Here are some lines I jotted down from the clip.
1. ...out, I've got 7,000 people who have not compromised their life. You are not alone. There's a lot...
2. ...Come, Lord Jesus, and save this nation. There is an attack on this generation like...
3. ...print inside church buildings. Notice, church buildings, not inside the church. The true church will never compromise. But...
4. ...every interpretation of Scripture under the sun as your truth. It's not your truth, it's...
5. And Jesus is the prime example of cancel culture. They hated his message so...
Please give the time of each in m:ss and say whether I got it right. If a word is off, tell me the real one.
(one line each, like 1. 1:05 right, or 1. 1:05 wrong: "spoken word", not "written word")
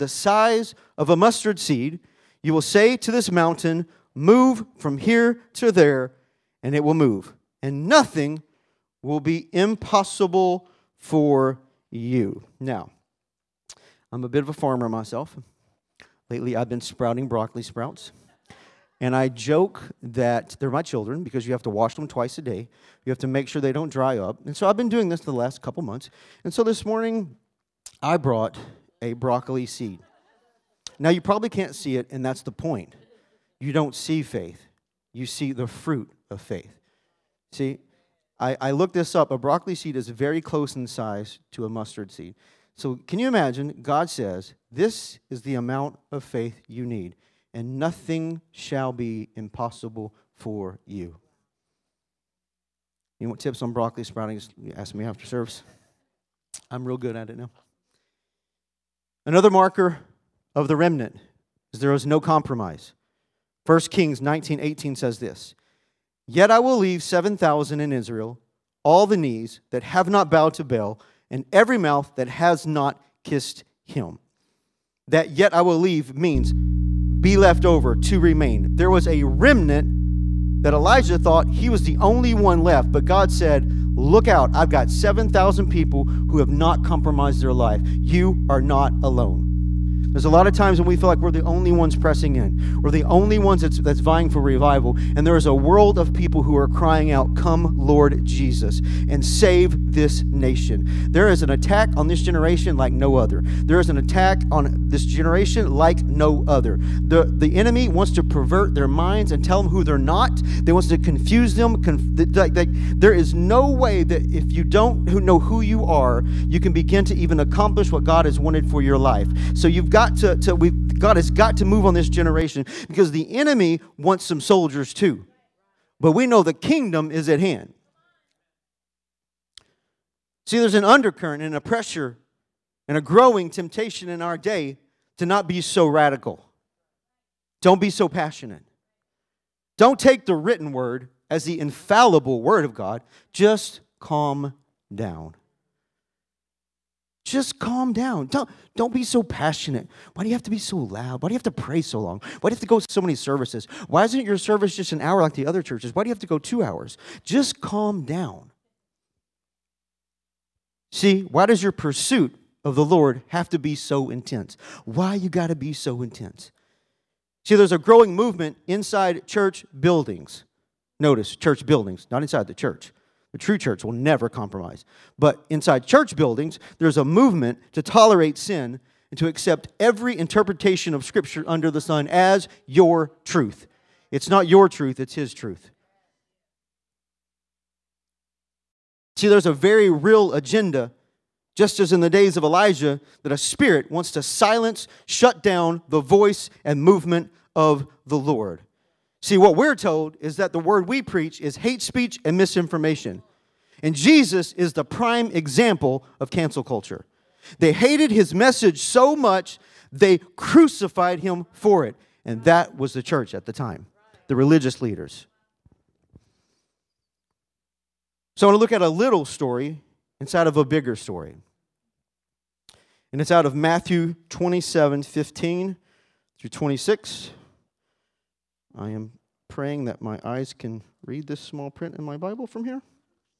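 1. 1:24 right
2. 1:37 right
3. 2:48 wrong: "movement", not "print"
4. 2:59 right
5. 3:23 right.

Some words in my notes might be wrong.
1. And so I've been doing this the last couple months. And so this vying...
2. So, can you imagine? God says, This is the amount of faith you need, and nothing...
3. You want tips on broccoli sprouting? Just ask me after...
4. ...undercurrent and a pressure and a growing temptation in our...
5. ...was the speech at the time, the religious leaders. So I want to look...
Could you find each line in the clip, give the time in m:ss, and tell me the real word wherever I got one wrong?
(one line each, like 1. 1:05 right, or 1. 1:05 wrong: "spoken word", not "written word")
1. 0:24 wrong: "morning", not "vying"
2. 0:42 right
3. 0:53 right
4. 2:10 right
5. 3:32 wrong: "church", not "speech".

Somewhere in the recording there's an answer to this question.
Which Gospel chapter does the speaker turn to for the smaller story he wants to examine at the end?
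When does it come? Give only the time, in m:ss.
3:43.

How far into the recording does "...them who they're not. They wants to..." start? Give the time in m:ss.
1:49.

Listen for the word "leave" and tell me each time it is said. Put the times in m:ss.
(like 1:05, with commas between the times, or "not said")
1:06, 1:15.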